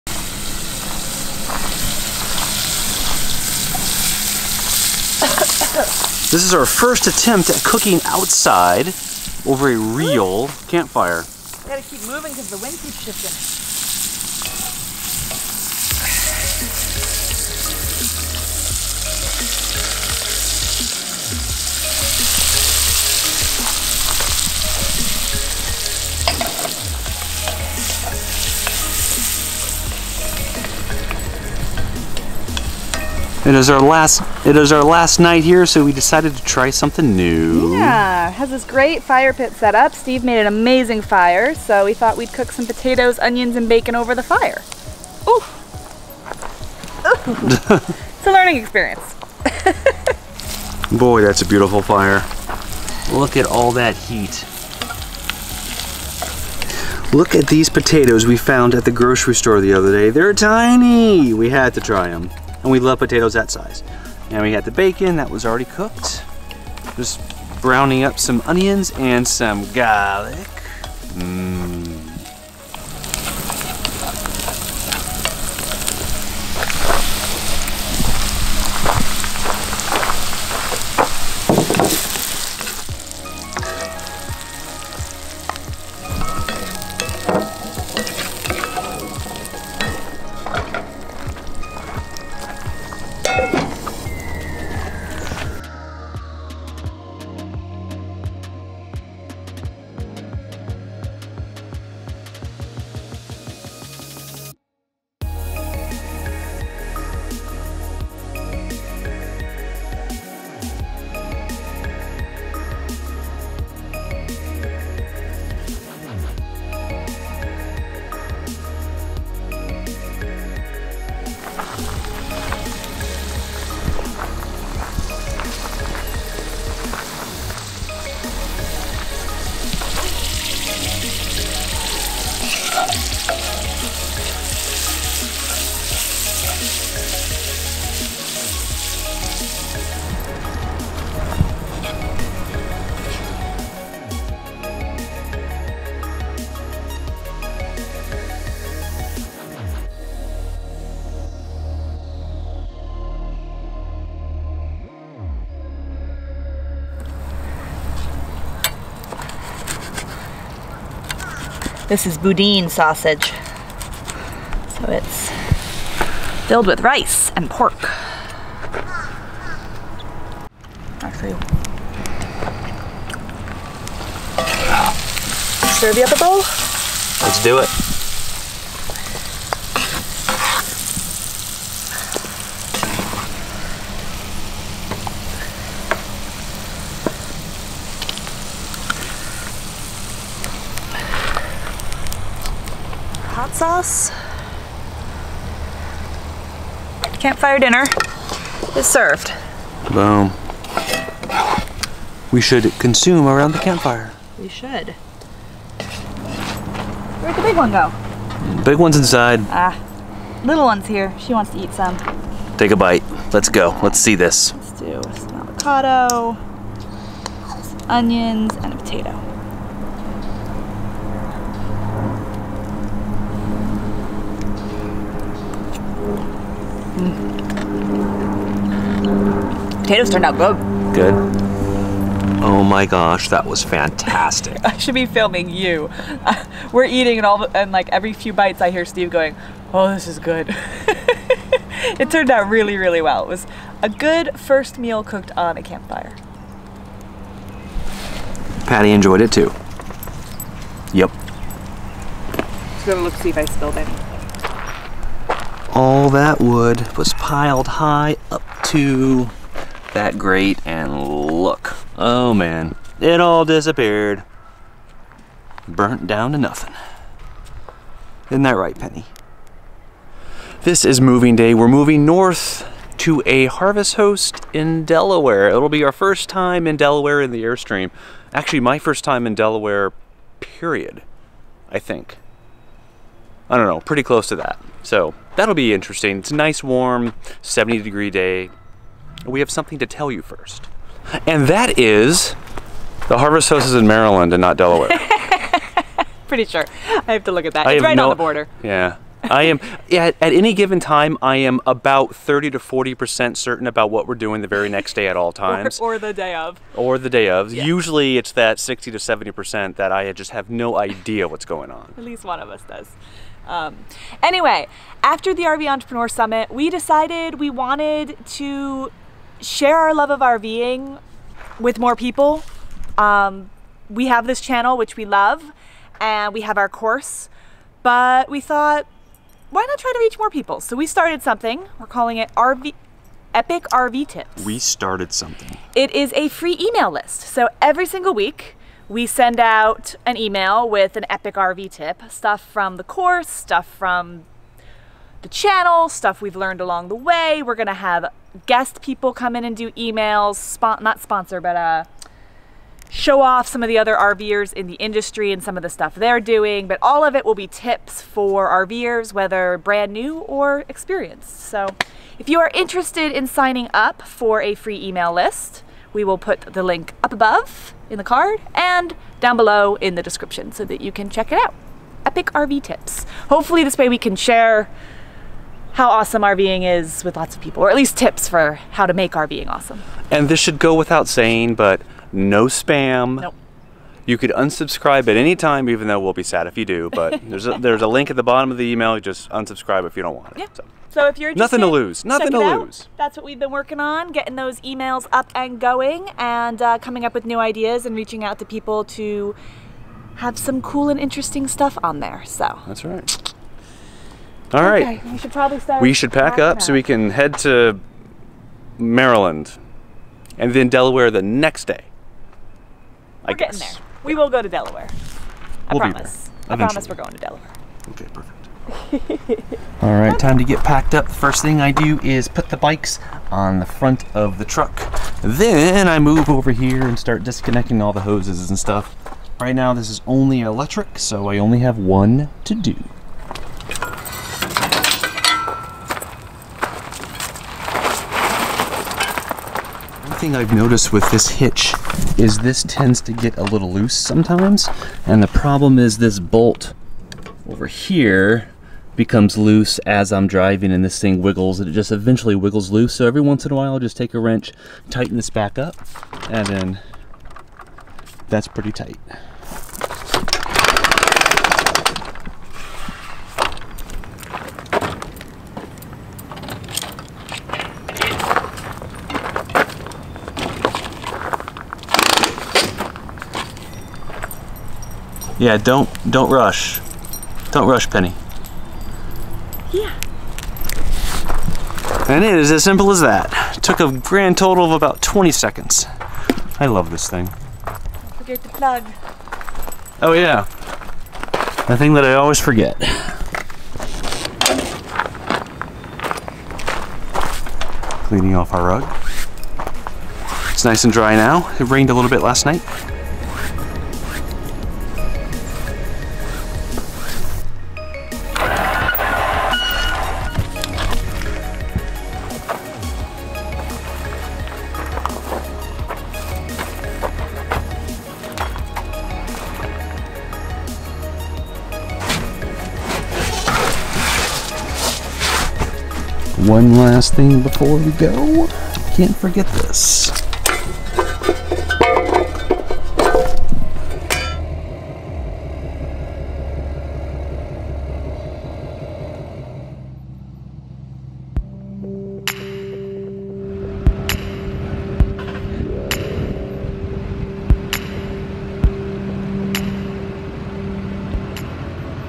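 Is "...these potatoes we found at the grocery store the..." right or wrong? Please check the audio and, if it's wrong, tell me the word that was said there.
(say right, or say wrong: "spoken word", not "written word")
right.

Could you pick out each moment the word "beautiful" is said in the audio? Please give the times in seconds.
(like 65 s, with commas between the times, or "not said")
51 s.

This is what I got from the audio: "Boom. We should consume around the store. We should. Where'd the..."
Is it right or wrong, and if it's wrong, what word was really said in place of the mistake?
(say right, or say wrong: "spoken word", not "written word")
wrong: "campfire", not "store".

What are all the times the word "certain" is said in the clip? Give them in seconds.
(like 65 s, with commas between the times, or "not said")
303 s.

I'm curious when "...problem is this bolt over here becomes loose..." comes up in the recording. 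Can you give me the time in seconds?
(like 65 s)
445 s.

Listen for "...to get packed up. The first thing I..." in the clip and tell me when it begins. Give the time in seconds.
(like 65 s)
420 s.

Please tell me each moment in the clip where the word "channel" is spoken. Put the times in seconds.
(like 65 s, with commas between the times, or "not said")
324 s, 345 s.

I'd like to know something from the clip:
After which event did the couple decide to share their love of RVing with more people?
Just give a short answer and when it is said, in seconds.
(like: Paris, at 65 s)
RV Entrepreneur Summit, at 315 s.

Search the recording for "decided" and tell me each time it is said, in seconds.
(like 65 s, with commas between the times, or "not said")
35 s, 316 s.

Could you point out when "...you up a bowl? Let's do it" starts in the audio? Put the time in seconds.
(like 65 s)
175 s.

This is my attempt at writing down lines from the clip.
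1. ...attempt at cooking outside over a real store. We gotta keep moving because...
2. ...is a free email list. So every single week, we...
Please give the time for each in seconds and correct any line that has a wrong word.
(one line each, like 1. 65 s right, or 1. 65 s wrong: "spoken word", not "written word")
1. 7 s wrong: "campfire", not "store"
2. 335 s right.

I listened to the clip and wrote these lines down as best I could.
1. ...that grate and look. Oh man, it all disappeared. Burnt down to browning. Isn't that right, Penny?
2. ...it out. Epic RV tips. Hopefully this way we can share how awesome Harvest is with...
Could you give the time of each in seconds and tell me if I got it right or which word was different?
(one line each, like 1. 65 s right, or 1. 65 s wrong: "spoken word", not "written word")
1. 259 s wrong: "nothing", not "browning"
2. 371 s wrong: "RVing", not "Harvest".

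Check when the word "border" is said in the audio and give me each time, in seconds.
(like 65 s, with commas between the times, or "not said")
298 s.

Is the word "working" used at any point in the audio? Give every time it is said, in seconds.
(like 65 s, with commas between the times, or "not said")
393 s.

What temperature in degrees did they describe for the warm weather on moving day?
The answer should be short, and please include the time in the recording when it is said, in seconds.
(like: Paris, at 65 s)
70, at 287 s.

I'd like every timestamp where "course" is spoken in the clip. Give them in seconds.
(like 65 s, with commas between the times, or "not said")
326 s, 342 s.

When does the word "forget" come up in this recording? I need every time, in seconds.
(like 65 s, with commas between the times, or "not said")
488 s, 492 s, 529 s.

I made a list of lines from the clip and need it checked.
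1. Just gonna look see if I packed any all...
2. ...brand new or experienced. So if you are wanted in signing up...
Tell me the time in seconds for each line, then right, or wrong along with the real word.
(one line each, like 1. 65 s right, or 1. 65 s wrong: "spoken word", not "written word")
1. 252 s wrong: "spilled", not "packed"
2. 359 s wrong: "interested", not "wanted".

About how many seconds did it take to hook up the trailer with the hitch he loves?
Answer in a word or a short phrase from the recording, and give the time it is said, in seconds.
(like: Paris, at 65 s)
20, at 485 s.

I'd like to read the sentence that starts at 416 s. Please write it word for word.
I promise we're going to Delaware.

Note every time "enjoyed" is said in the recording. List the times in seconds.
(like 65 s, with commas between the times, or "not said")
248 s.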